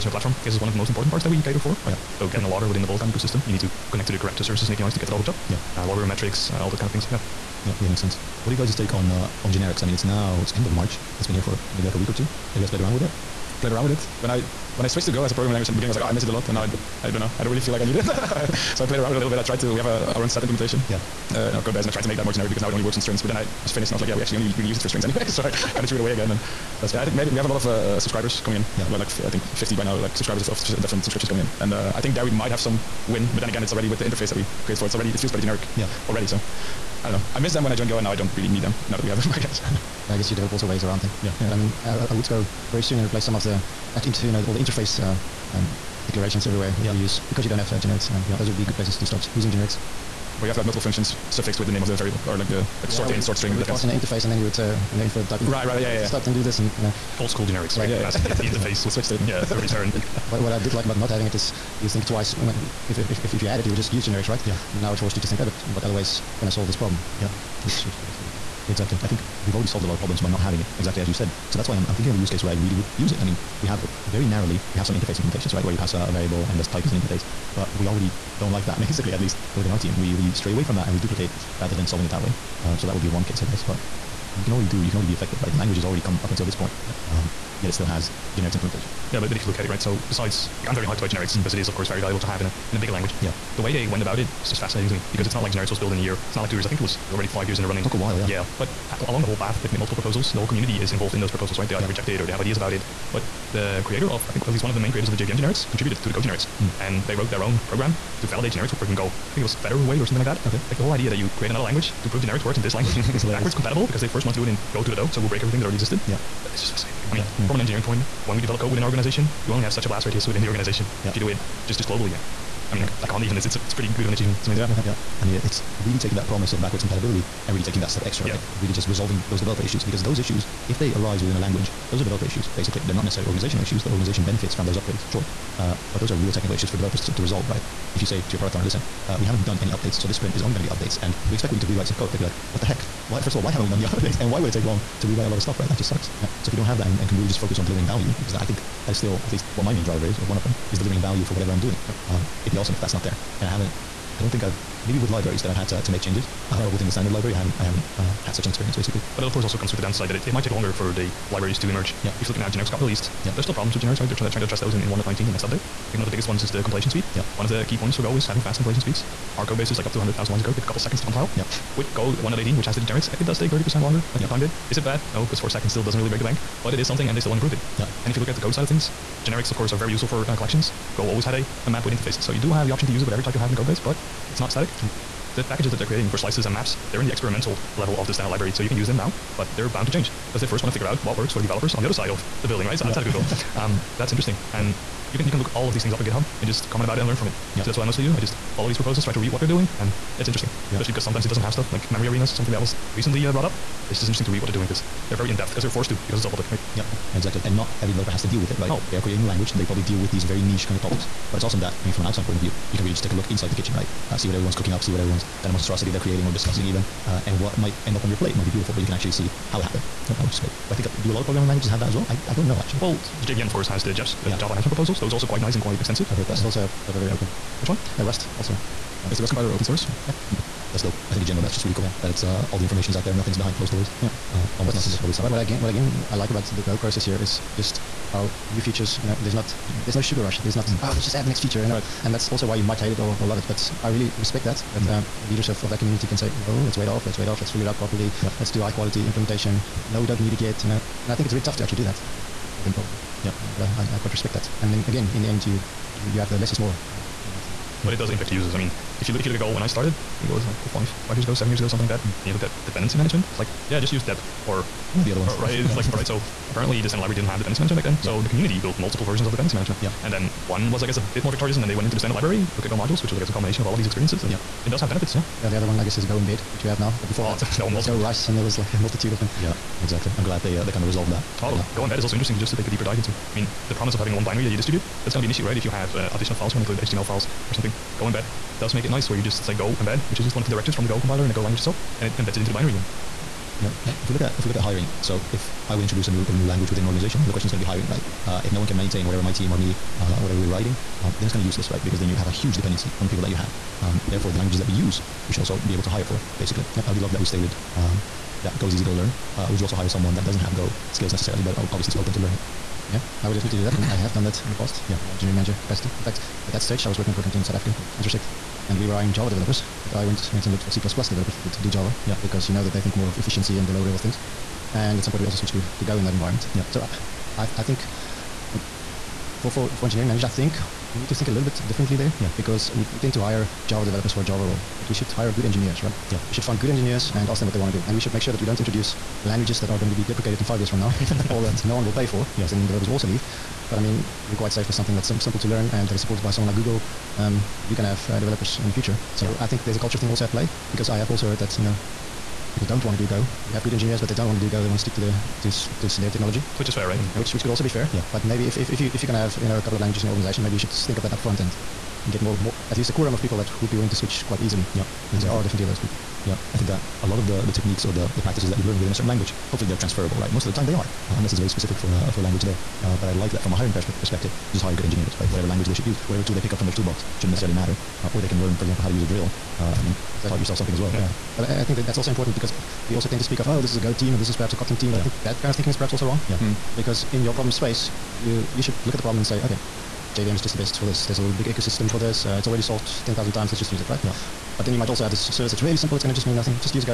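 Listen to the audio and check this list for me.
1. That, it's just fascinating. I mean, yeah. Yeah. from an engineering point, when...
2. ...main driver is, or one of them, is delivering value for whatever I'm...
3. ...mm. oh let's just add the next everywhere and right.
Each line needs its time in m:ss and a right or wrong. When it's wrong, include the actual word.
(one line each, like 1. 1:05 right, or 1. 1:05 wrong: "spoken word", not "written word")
1. 1:56 right
2. 2:29 right
3. 4:00 wrong: "feature", not "everywhere".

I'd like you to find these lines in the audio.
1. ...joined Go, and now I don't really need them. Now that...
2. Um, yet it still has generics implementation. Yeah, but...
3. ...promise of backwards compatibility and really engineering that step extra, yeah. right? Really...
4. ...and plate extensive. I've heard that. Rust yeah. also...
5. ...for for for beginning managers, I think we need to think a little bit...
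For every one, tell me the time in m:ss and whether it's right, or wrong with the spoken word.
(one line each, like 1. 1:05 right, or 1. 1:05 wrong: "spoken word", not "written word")
1. 0:37 right
2. 1:27 right
3. 2:06 wrong: "taking", not "engineering"
4. 3:45 wrong: "quite", not "plate"
5. 5:29 wrong: "engineering", not "beginning".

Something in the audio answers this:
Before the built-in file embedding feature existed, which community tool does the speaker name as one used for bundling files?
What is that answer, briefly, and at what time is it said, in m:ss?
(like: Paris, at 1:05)
Go Rice, at 4:37.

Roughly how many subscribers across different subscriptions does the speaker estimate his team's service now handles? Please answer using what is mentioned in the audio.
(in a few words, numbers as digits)
50.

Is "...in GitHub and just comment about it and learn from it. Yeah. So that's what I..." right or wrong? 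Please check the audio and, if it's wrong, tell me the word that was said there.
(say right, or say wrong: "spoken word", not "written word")
right.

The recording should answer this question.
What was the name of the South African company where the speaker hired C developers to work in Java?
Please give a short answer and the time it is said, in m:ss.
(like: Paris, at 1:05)
Intersect, at 5:17.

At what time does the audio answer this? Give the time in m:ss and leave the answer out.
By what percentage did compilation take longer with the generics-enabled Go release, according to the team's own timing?
2:53.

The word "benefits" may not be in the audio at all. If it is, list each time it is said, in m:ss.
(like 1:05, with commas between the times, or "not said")
2:14, 4:34.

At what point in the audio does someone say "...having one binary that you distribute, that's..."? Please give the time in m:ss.
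4:43.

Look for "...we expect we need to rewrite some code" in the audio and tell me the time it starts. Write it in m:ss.
2:21.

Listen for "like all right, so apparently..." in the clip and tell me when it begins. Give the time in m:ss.
4:25.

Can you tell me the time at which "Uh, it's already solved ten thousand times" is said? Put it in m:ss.
6:32.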